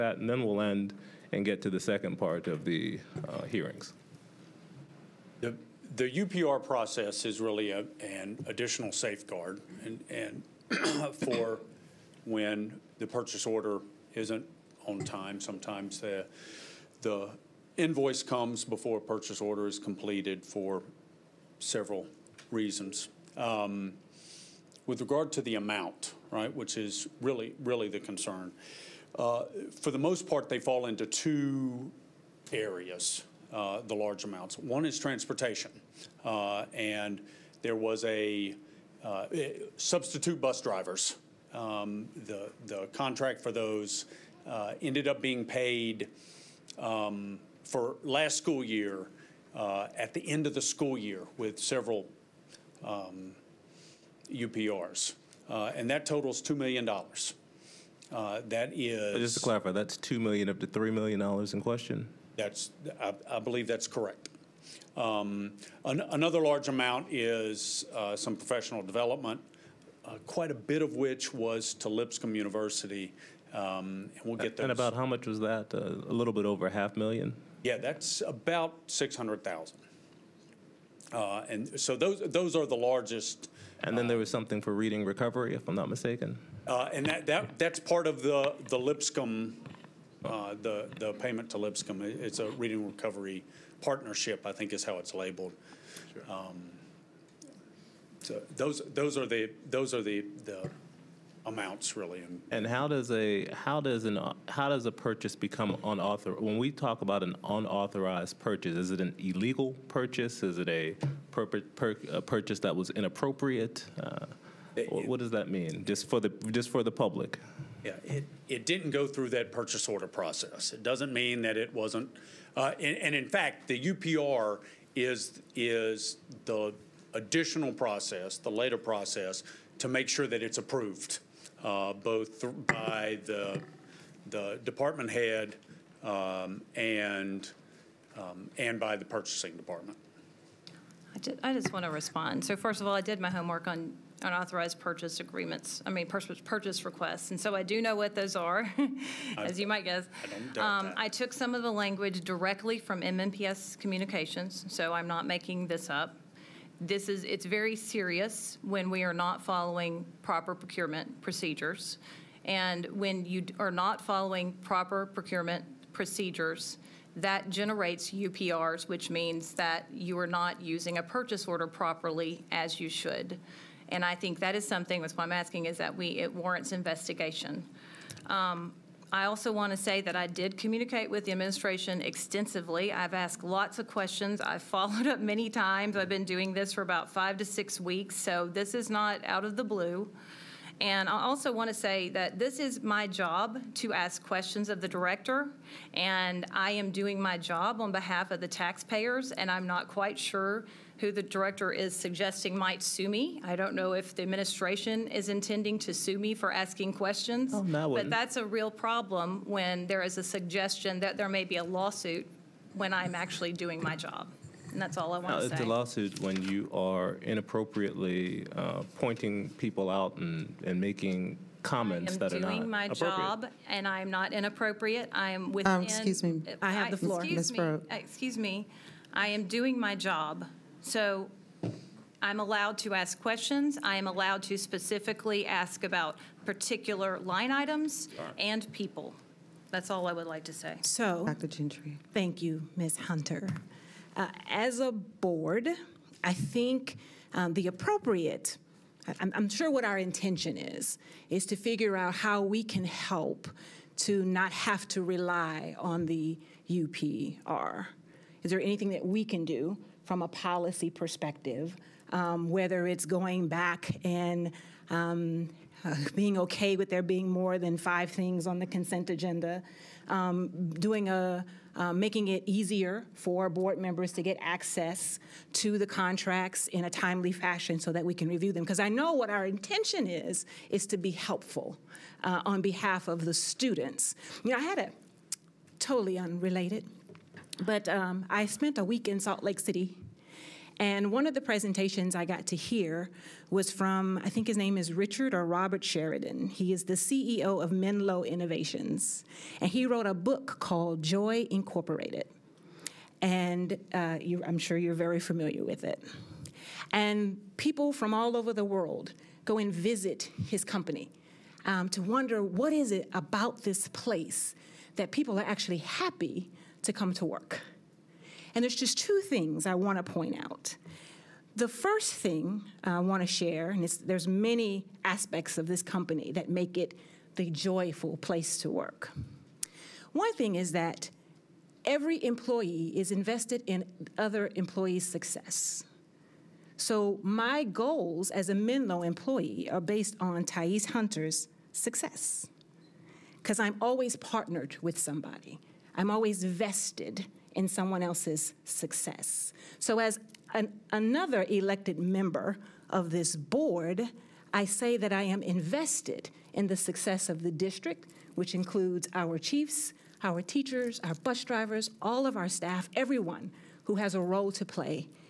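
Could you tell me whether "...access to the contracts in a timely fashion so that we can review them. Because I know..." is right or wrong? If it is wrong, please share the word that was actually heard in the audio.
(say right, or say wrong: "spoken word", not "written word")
right.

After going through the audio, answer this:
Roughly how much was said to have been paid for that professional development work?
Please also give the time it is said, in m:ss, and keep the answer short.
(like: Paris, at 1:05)
600,000, at 1:18.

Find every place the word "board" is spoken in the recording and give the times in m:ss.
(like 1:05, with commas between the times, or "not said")
4:04, 4:33, 5:53.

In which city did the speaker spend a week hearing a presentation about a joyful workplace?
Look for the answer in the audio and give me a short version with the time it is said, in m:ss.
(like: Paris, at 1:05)
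Salt Lake City, at 4:49.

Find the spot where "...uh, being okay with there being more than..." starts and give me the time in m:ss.
4:25.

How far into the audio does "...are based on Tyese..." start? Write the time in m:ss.
5:39.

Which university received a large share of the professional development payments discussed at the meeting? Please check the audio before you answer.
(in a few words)
Lipscomb University.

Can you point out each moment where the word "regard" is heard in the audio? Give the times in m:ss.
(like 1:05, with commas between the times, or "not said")
0:25.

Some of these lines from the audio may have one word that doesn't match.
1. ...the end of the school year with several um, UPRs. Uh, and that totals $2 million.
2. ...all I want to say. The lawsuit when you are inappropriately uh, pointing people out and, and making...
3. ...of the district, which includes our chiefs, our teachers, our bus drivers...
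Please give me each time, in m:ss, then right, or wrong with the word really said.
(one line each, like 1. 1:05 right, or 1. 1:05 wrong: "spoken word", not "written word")
1. 0:50 right
2. 3:34 right
3. 5:57 right.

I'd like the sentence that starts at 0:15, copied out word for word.
Sometimes the, the invoice comes before a purchase order is completed for several reasons.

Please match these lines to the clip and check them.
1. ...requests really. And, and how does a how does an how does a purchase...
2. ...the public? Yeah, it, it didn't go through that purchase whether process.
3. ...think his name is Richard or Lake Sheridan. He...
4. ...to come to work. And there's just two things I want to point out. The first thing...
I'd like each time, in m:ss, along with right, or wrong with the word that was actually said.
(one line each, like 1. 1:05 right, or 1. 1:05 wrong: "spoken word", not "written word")
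1. 1:41 wrong: "amounts", not "requests"
2. 1:56 wrong: "order", not "whether"
3. 4:54 wrong: "Robert", not "Lake"
4. 5:16 right.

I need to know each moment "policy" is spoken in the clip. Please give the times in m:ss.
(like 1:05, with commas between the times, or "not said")
4:20.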